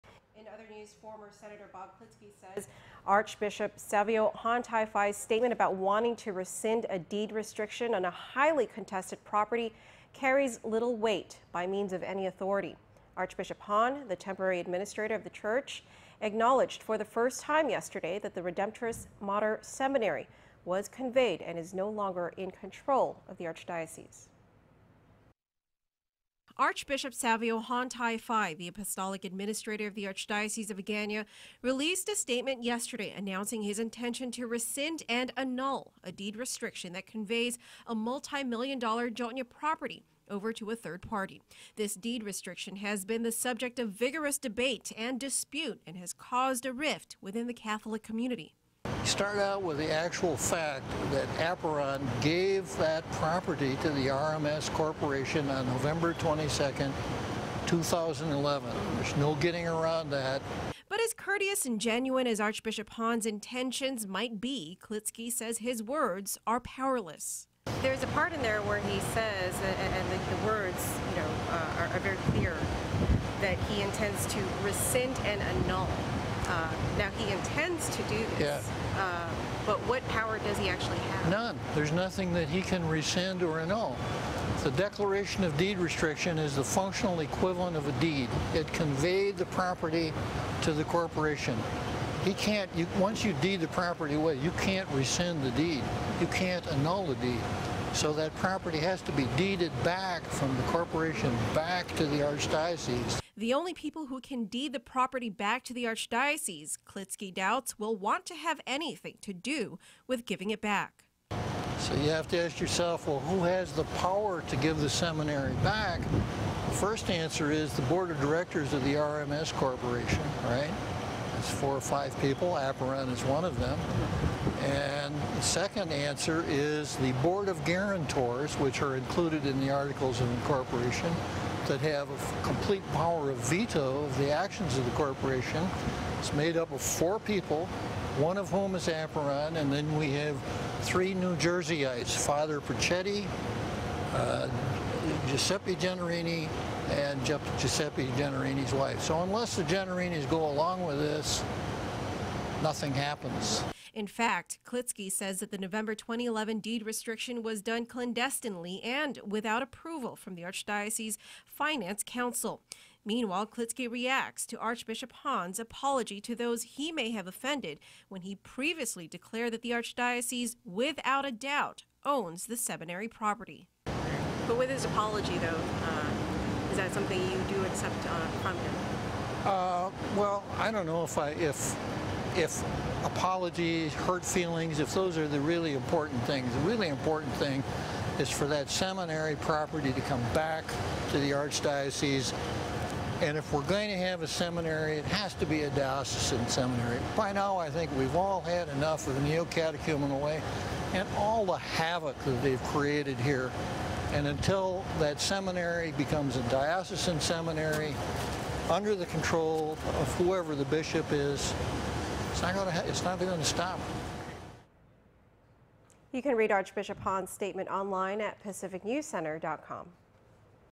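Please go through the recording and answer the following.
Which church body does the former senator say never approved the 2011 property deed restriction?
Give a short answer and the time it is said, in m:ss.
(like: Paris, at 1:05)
Archdiocese Finance Council, at 2:40.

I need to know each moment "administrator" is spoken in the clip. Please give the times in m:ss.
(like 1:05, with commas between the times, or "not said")
0:14, 0:29.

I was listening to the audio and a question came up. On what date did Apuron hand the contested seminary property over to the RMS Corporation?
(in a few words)
November 22, 2011.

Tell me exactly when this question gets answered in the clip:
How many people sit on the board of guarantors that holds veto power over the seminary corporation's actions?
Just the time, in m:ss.
2:16.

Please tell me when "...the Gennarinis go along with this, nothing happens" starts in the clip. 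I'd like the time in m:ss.
2:29.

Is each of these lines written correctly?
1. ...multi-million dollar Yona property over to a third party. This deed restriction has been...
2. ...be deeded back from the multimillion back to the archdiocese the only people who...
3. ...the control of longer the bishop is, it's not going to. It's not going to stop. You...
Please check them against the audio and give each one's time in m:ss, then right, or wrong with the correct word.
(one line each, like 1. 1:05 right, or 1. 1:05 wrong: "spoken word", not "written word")
1. 0:37 right
2. 1:39 wrong: "corporation", not "multimillion"
3. 3:28 wrong: "whoever", not "longer".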